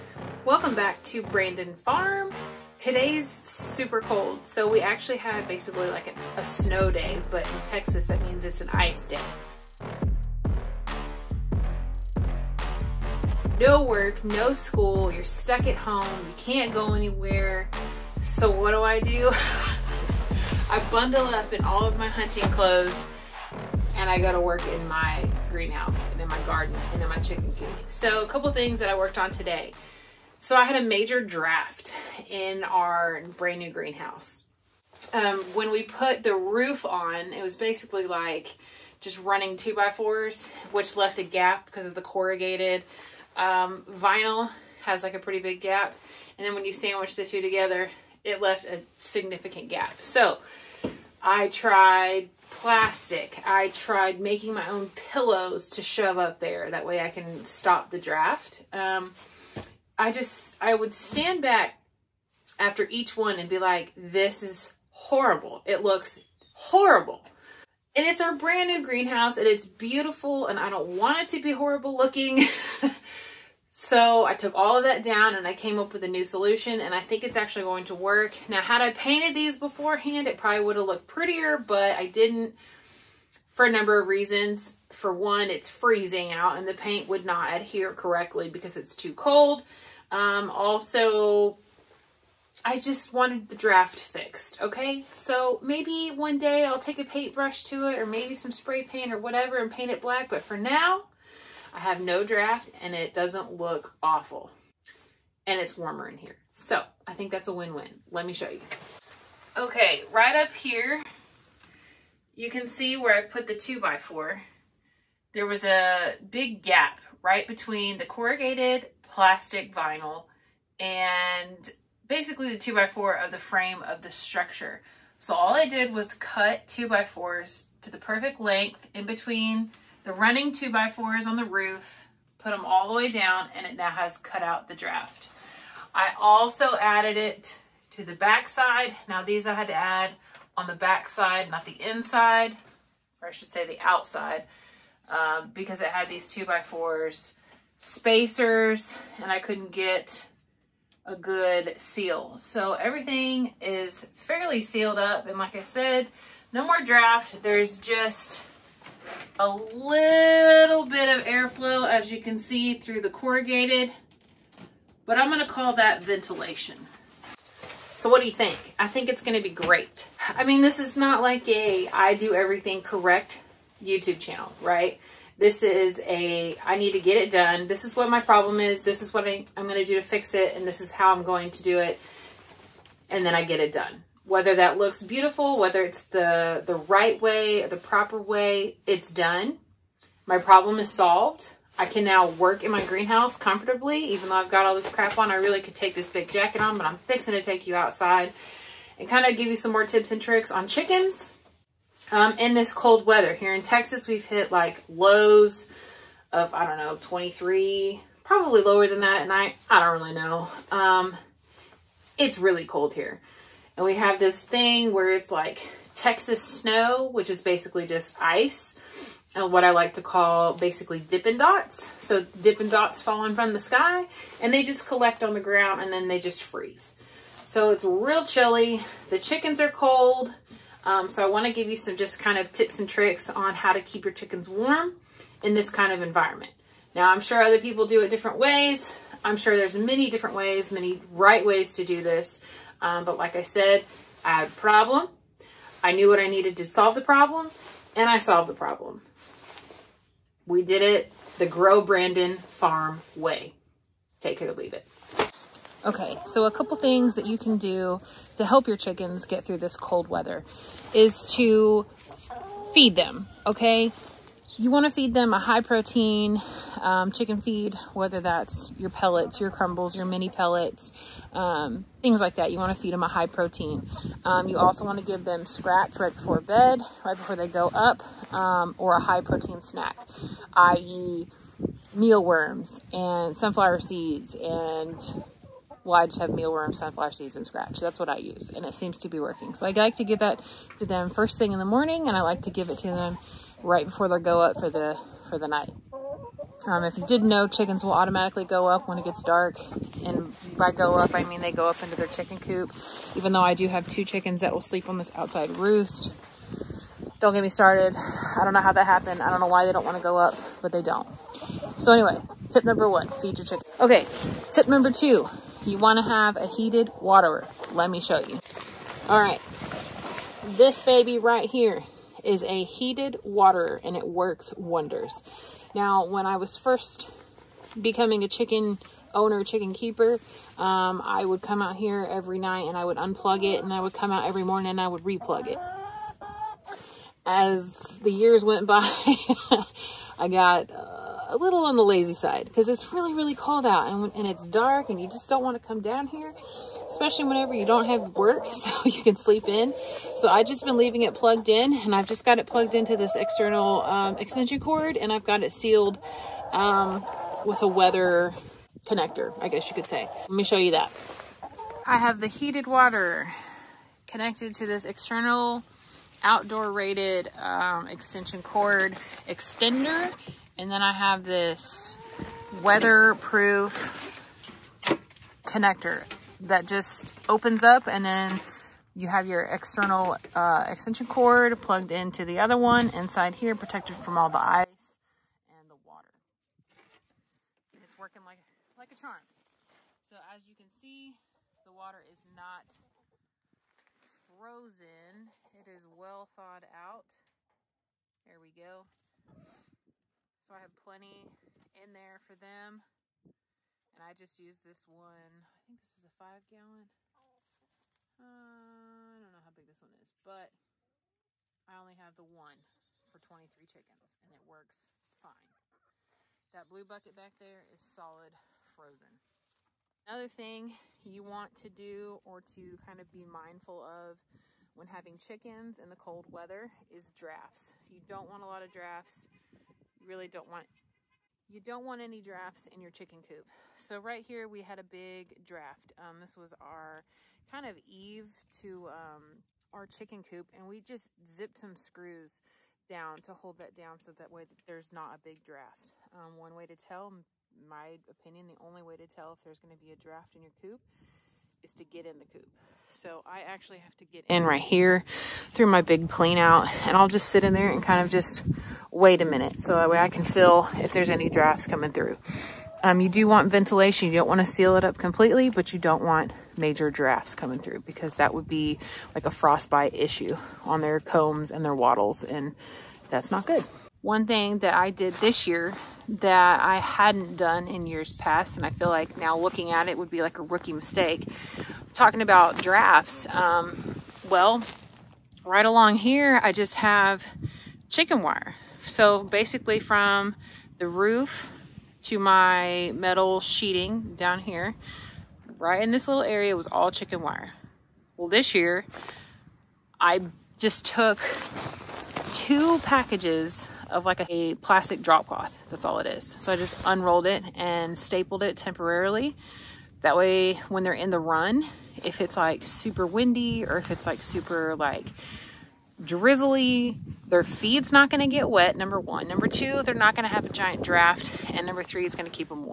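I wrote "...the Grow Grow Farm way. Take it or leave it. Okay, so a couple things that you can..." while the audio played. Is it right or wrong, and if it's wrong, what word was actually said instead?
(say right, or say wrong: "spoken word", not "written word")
wrong: "Brandon", not "Grow".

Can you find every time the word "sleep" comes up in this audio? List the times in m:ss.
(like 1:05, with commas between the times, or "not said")
5:04, 5:49.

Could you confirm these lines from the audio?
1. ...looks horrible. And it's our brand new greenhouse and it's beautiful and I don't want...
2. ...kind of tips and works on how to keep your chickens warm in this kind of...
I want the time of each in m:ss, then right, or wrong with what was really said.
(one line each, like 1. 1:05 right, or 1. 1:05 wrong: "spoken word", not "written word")
1. 1:05 right
2. 3:52 wrong: "tricks", not "works".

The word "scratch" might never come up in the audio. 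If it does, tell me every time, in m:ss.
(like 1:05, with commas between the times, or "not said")
4:35, 4:47.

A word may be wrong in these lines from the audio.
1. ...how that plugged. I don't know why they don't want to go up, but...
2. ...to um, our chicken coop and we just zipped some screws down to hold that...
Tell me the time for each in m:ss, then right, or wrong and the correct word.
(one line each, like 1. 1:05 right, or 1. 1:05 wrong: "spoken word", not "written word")
1. 5:08 wrong: "happened", not "plugged"
2. 7:18 right.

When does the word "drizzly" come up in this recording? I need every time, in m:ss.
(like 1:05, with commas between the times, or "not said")
8:36.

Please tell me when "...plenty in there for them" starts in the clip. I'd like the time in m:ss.
6:40.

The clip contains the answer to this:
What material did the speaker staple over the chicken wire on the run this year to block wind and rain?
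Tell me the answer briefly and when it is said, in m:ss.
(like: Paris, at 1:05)
Plastic drop cloth, at 8:24.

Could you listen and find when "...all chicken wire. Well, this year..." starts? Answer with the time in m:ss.
8:16.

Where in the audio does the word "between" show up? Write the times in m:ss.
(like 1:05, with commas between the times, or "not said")
1:57, 2:09.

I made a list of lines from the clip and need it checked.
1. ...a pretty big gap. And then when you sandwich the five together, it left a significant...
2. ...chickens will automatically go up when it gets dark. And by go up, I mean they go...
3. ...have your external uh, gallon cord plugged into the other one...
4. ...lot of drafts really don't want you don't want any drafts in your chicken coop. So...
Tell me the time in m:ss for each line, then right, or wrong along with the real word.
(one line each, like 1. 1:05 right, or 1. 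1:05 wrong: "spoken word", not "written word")
1. 0:45 wrong: "two", not "five"
2. 4:57 right
3. 6:19 wrong: "extension", not "gallon"
4. 7:08 right.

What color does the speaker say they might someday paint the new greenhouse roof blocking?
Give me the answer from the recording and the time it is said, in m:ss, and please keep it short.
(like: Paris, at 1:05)
Black, at 1:40.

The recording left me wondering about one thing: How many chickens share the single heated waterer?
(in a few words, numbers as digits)
23.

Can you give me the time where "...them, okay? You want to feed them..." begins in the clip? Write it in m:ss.
4:22.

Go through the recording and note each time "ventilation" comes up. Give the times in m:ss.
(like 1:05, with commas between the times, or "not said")
2:46, 7:43.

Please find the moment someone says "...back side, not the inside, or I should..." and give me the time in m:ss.
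2:20.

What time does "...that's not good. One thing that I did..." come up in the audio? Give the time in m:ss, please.
7:53.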